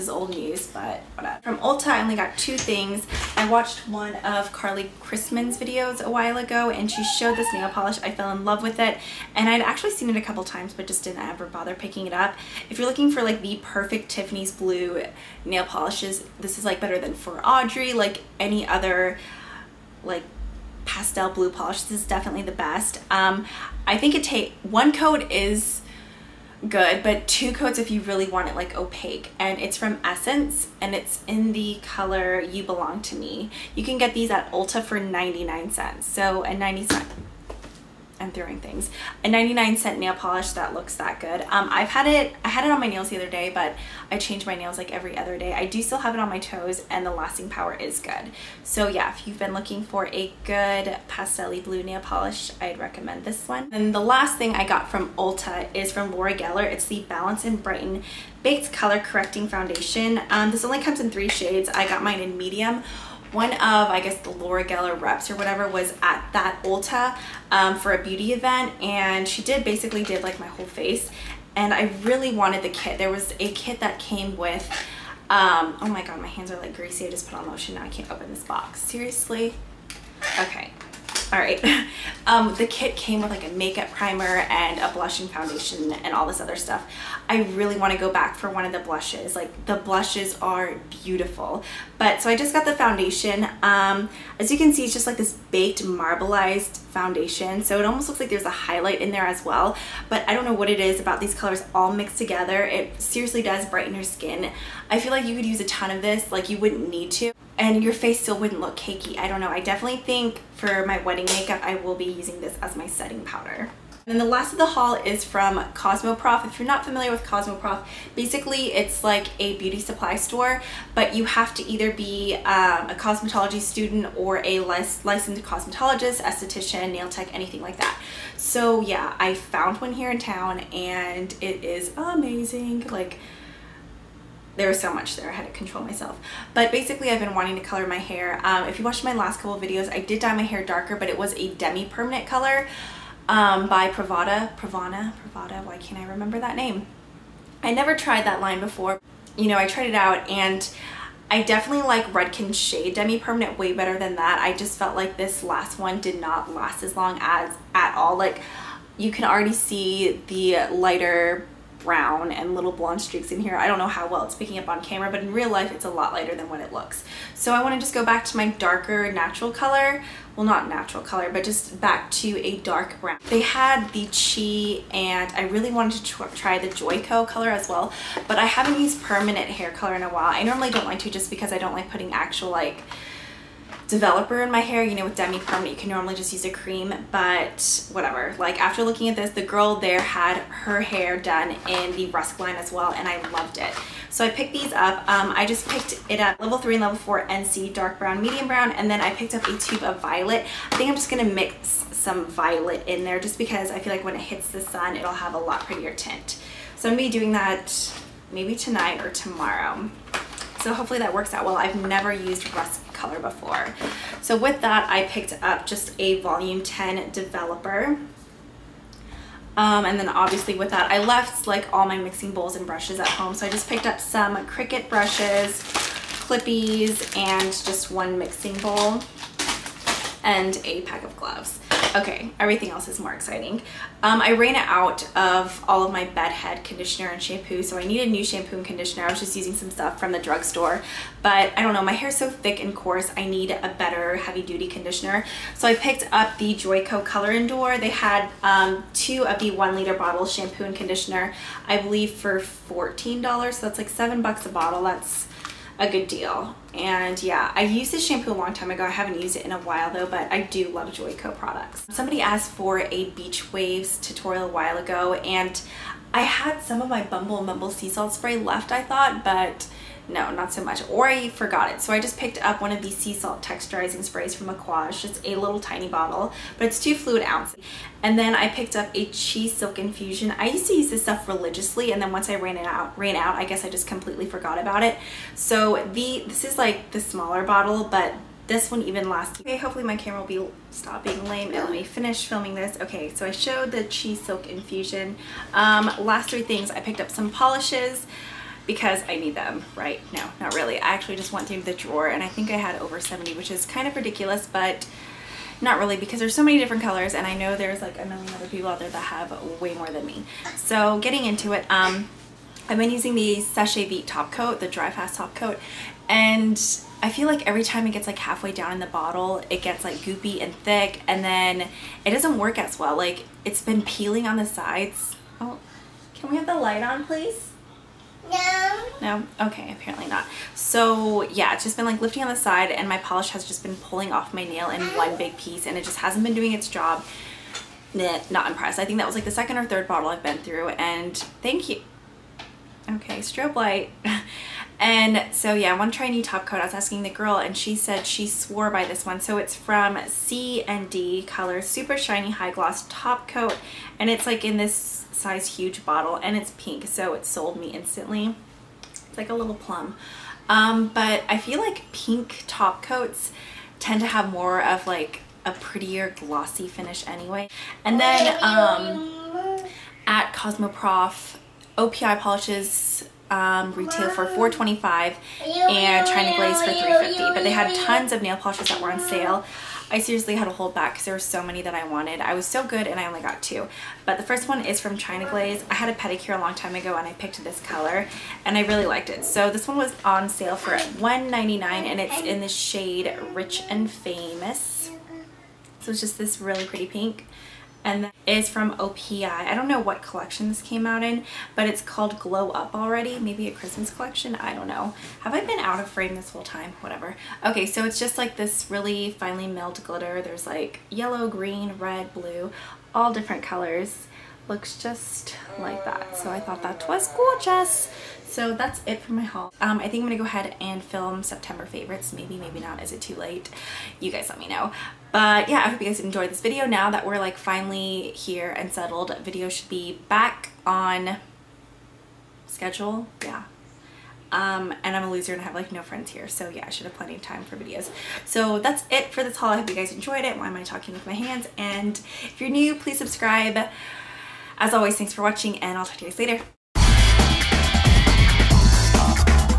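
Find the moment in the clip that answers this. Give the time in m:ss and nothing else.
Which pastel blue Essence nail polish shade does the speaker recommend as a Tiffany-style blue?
0:32.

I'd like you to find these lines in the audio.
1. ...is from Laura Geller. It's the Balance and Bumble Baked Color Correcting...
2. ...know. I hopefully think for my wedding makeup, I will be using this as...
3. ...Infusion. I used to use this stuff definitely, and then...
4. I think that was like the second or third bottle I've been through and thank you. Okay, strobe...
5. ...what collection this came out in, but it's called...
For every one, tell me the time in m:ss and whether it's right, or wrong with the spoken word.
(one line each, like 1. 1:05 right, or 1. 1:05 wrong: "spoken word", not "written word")
1. 0:55 wrong: "Brighten", not "Bumble"
2. 1:49 wrong: "definitely", not "hopefully"
3. 4:39 wrong: "religiously", not "definitely"
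4. 5:38 right
5. 6:39 right.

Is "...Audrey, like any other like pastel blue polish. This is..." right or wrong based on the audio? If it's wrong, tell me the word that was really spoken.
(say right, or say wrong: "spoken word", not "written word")
right.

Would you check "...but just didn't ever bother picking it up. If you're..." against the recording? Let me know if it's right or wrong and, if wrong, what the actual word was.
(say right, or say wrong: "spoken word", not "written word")
right.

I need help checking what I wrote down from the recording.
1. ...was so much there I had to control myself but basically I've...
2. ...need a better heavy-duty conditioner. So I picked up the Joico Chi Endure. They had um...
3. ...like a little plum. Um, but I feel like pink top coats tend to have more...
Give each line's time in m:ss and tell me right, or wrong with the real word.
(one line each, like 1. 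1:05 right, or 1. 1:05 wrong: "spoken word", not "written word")
1. 2:14 right
2. 4:03 wrong: "Color", not "Chi"
3. 5:59 right.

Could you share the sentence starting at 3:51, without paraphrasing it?
Okay, everything else is more exciting.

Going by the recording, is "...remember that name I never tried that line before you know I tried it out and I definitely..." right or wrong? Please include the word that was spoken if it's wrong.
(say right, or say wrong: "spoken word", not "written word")
right.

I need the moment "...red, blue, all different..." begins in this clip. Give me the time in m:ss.
6:51.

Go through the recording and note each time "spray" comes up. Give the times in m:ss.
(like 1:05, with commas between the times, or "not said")
4:28, 4:34.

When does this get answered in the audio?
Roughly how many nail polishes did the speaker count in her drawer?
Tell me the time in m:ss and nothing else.
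5:02.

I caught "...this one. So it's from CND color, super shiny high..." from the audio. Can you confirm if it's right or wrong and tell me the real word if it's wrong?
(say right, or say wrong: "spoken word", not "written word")
right.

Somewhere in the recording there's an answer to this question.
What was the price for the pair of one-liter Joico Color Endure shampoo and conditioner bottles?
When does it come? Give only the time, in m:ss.
4:12.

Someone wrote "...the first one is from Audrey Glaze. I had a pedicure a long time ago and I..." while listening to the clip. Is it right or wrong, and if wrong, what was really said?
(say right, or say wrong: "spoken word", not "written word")
wrong: "China", not "Audrey".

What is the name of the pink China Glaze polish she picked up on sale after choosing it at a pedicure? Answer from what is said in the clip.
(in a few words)
Rich and Famous.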